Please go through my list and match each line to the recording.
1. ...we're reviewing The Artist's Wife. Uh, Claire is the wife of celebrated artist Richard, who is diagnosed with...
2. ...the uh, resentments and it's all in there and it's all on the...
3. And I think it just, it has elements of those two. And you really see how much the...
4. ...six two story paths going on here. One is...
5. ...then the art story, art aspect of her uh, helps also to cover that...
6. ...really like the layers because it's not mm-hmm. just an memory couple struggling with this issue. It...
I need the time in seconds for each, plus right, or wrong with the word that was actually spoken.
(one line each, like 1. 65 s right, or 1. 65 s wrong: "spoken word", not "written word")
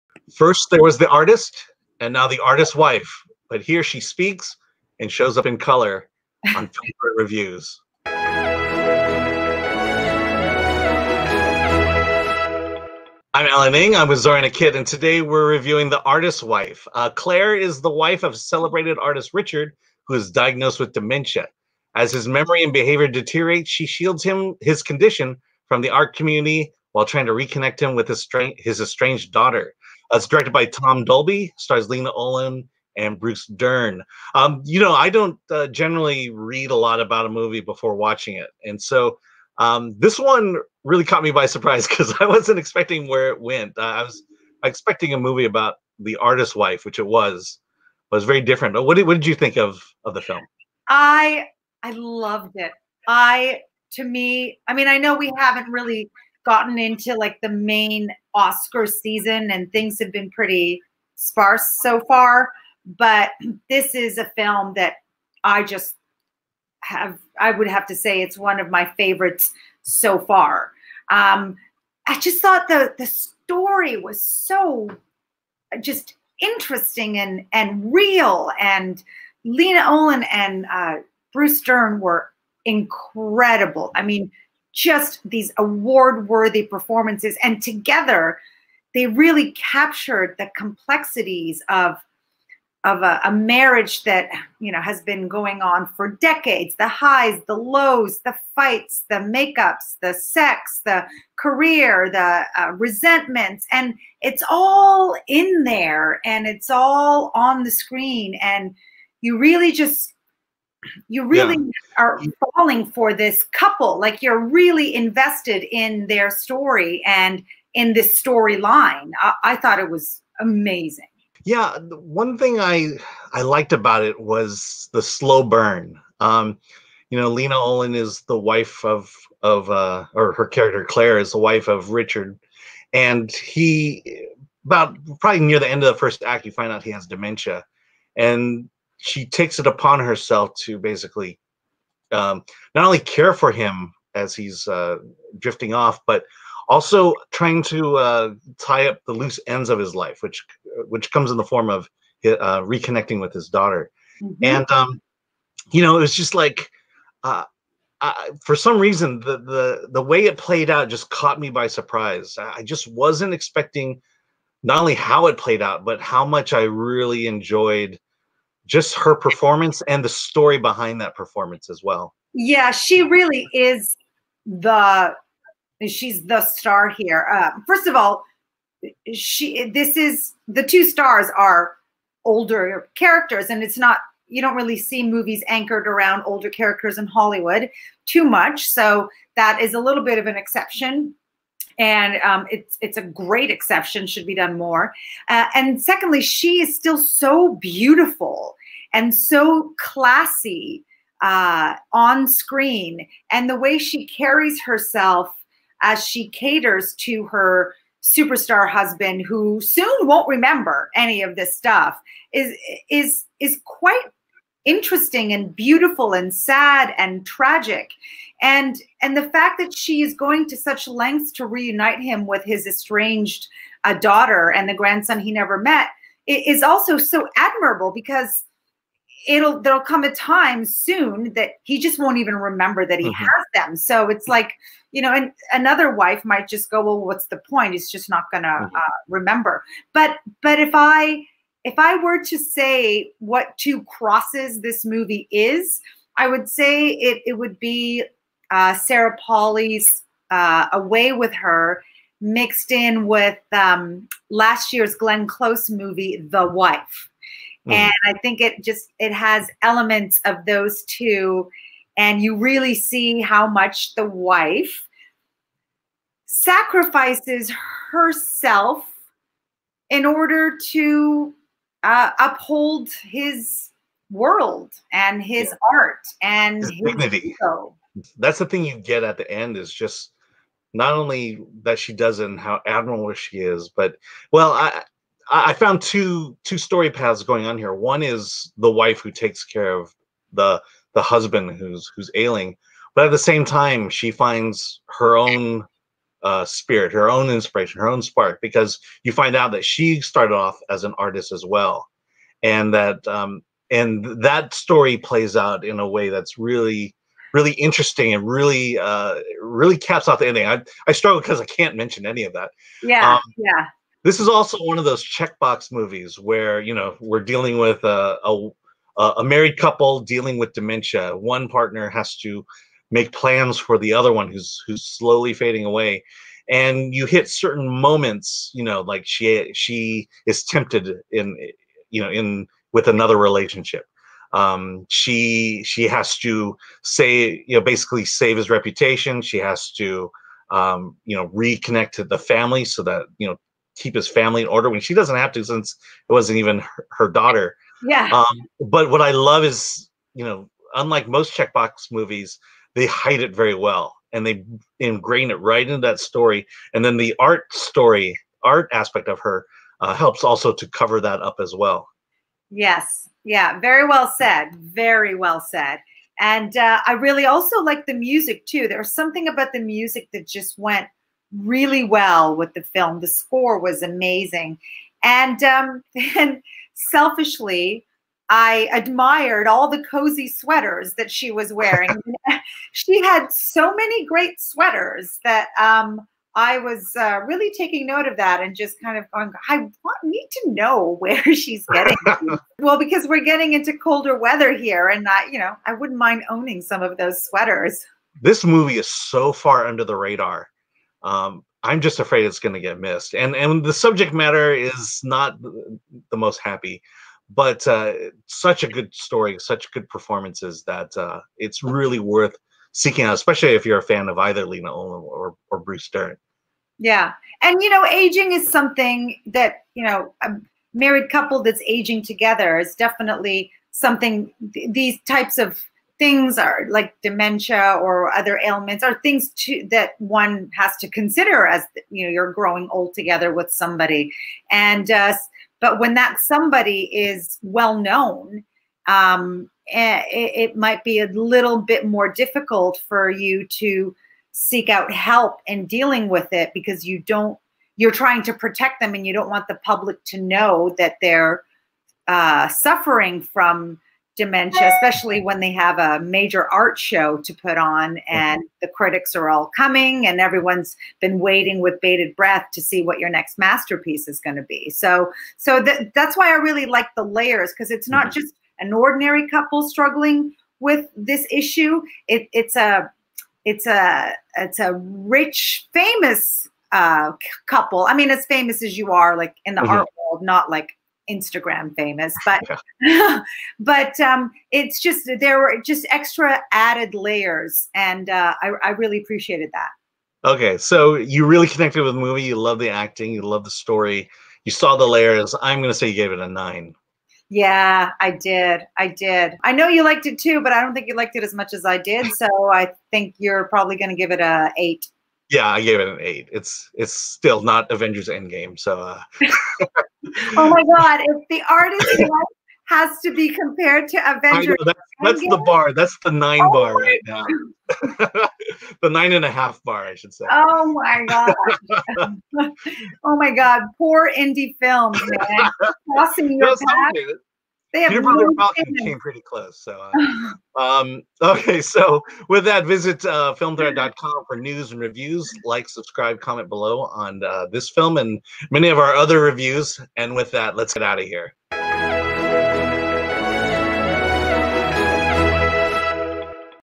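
1. 15 s right
2. 102 s right
3. 257 s right
4. 285 s wrong: "two", not "six"
5. 356 s right
6. 466 s wrong: "ordinary", not "memory".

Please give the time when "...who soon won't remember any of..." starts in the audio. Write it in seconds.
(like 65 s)
209 s.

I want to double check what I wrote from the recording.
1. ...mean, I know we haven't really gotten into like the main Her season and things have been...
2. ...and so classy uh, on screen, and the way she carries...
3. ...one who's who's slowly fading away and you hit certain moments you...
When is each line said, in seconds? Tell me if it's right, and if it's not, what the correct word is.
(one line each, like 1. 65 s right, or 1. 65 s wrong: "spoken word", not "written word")
1. 54 s wrong: "Oscar", not "Her"
2. 198 s right
3. 324 s right.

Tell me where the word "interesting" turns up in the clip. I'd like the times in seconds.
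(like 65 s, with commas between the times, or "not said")
76 s, 214 s, 307 s.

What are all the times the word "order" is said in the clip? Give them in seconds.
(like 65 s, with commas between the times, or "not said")
270 s, 344 s.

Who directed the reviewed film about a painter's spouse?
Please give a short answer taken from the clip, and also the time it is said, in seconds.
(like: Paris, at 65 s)
Tom Dolby, at 30 s.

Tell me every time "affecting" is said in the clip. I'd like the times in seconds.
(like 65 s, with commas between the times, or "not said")
not said.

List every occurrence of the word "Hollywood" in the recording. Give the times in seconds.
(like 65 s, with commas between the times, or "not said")
187 s.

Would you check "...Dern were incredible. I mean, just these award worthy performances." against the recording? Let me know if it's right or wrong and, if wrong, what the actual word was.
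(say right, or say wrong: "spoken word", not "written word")
right.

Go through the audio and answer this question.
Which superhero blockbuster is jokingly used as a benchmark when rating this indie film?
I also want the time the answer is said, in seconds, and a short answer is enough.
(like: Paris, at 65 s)
Avengers Endgame, at 507 s.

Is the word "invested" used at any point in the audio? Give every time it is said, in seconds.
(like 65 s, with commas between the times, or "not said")
114 s.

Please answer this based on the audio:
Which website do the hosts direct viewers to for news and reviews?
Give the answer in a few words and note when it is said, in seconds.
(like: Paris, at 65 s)
filmthreat.com, at 533 s.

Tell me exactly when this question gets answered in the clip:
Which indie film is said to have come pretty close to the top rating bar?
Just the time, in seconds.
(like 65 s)
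527 s.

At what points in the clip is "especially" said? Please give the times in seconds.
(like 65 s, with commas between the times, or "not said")
413 s, 454 s.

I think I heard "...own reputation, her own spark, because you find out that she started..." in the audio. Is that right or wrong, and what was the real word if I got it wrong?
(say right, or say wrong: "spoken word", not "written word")
wrong: "inspiration", not "reputation".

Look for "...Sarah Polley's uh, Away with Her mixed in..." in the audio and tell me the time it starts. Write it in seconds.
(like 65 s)
248 s.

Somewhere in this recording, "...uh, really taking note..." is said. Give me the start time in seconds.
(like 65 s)
386 s.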